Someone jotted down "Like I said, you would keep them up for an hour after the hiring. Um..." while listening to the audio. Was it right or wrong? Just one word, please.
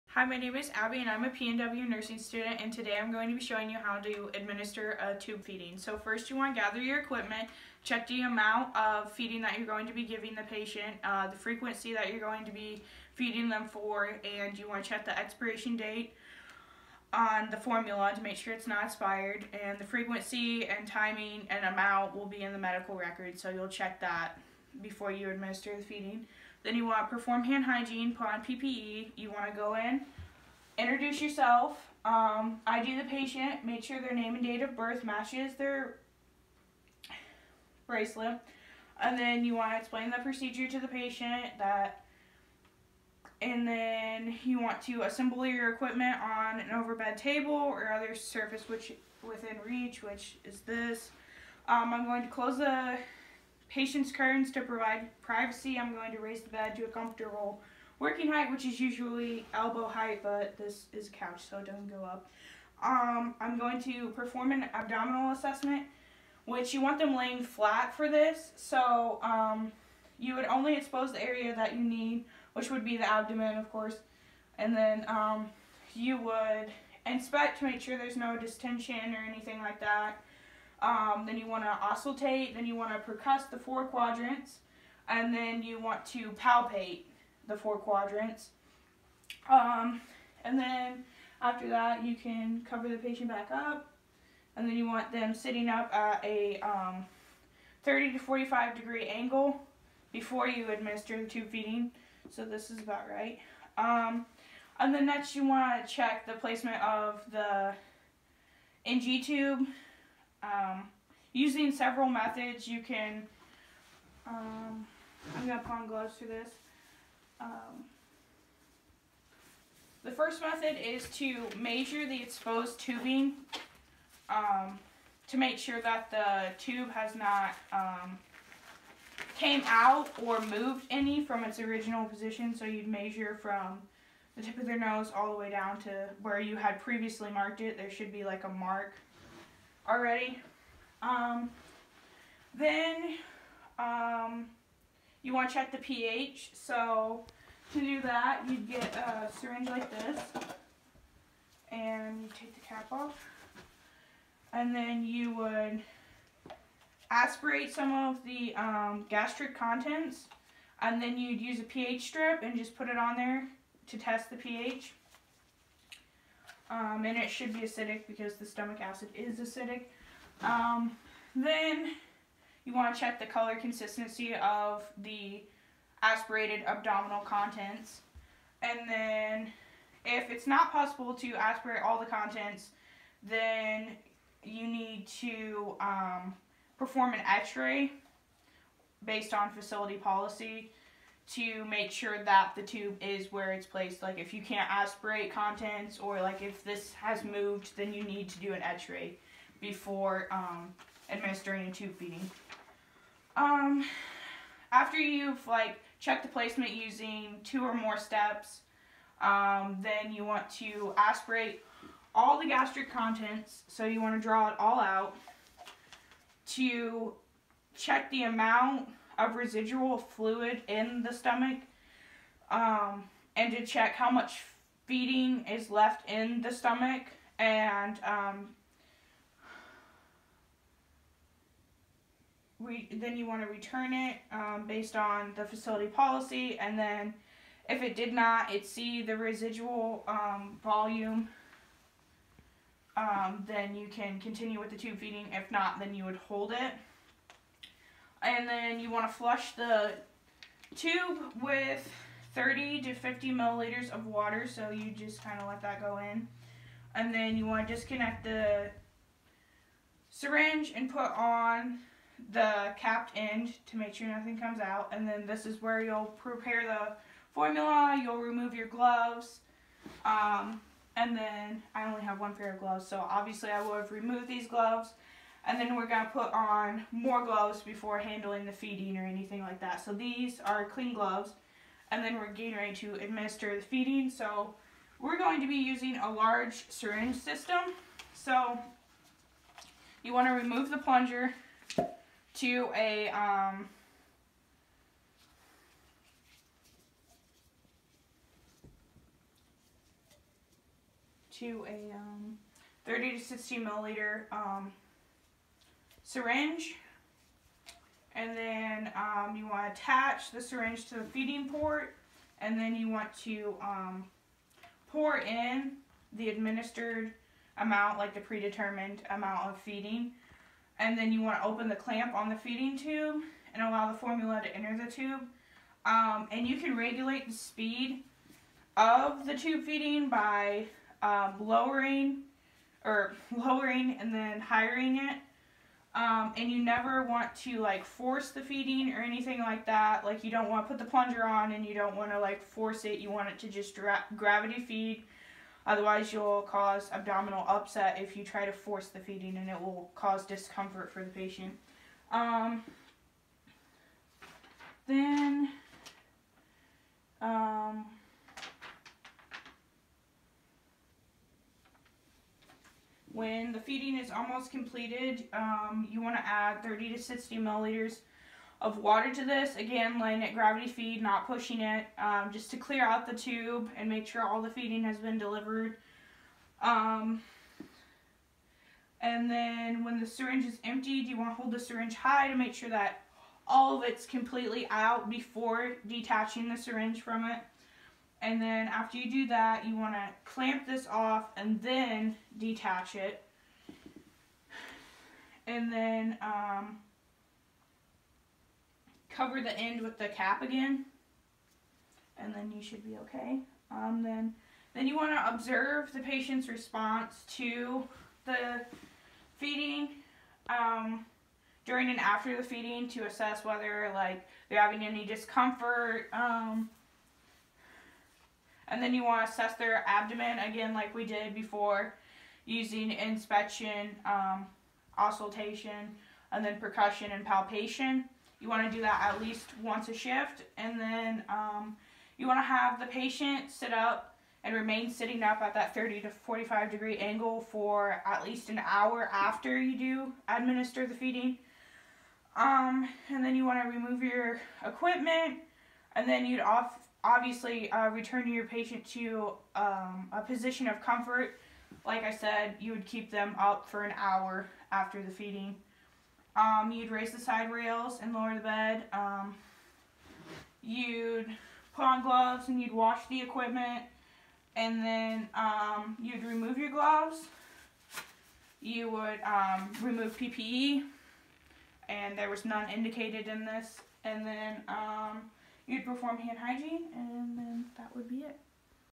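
wrong.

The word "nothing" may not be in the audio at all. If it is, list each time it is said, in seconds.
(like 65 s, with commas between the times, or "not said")
264 s.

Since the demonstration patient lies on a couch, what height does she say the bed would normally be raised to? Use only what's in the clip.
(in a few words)
elbow height.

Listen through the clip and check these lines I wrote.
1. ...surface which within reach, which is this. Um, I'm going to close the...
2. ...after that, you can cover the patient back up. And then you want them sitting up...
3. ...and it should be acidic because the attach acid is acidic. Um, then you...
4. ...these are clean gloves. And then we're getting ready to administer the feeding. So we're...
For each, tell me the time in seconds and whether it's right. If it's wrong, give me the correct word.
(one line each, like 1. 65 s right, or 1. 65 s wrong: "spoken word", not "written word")
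1. 48 s right
2. 91 s right
3. 167 s wrong: "stomach", not "attach"
4. 279 s right.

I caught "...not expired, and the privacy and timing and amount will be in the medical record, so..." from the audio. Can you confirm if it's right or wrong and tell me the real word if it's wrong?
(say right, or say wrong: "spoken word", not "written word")
wrong: "frequency", not "privacy".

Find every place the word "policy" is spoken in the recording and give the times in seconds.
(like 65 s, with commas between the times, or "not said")
189 s, 235 s.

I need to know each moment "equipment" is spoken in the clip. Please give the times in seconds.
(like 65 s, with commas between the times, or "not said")
6 s, 45 s, 444 s, 463 s.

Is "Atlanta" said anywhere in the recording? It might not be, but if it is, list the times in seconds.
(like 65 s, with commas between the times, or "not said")
not said.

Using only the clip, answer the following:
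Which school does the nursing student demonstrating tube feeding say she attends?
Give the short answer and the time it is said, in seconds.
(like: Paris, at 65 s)
PNW, at 1 s.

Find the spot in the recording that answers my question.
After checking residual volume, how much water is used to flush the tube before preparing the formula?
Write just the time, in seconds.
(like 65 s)
252 s.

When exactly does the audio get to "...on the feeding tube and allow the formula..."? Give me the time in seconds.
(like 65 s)
322 s.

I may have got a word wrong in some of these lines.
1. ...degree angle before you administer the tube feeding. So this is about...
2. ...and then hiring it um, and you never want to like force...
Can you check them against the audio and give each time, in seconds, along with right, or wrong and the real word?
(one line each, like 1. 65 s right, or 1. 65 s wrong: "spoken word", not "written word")
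1. 98 s right
2. 333 s right.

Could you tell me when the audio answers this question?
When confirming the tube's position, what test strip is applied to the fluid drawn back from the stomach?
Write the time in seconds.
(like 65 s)
161 s.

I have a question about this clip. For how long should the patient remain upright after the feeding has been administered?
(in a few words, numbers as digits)
at least an hour.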